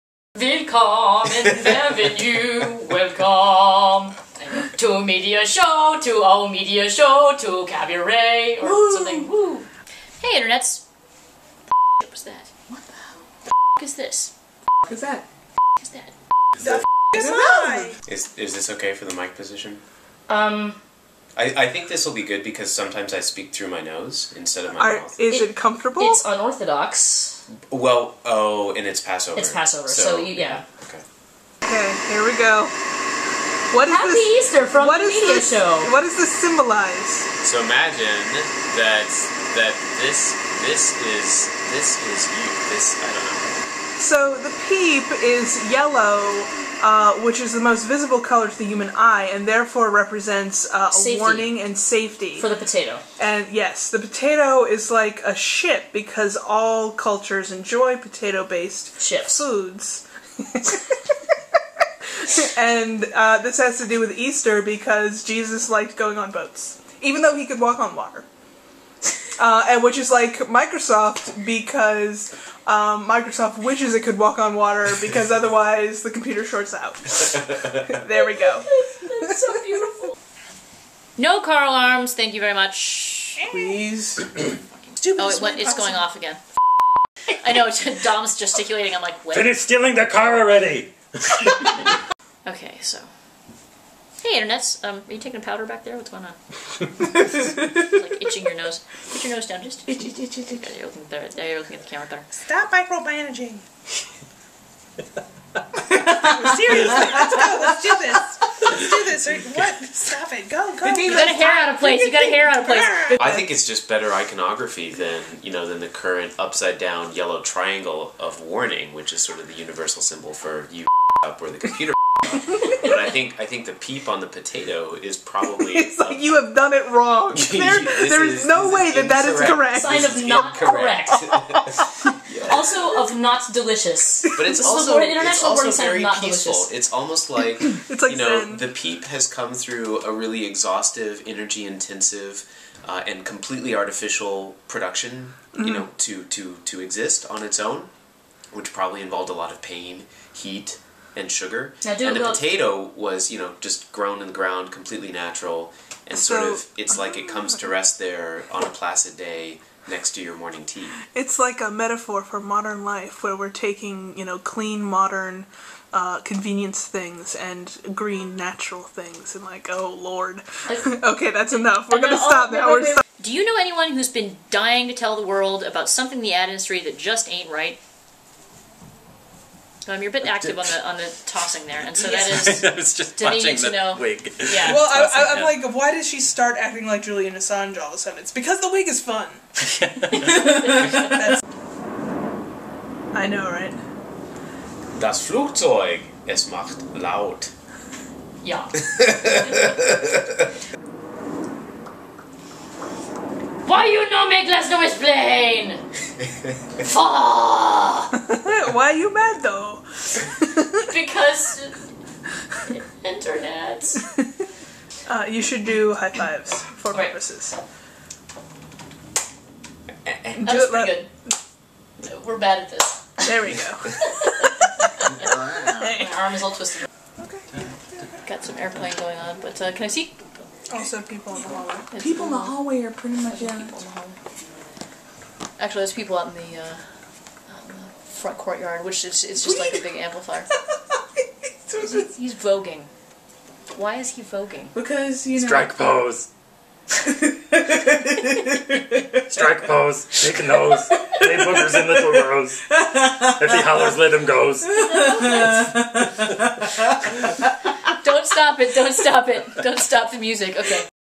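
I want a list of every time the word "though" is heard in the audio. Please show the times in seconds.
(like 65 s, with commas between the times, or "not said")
67 s, 209 s.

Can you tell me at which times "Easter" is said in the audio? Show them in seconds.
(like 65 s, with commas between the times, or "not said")
34 s, 64 s.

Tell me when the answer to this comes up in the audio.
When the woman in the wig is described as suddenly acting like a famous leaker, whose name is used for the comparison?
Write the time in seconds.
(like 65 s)
187 s.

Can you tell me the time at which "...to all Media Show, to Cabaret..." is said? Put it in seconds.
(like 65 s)
6 s.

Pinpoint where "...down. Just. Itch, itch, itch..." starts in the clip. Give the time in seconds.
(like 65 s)
99 s.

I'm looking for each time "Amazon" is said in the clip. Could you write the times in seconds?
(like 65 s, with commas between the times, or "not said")
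not said.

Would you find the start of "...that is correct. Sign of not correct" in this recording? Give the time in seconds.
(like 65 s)
129 s.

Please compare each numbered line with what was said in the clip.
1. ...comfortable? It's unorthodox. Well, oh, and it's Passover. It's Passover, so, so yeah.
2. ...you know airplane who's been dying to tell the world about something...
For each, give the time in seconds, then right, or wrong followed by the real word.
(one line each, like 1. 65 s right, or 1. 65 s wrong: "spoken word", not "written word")
1. 25 s right
2. 173 s wrong: "anyone", not "airplane".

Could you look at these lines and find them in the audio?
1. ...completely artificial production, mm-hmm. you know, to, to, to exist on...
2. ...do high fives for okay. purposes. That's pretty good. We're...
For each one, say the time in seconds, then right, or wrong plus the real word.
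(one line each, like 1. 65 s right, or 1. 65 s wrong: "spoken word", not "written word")
1. 143 s right
2. 215 s right.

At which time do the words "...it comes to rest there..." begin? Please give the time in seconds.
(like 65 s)
157 s.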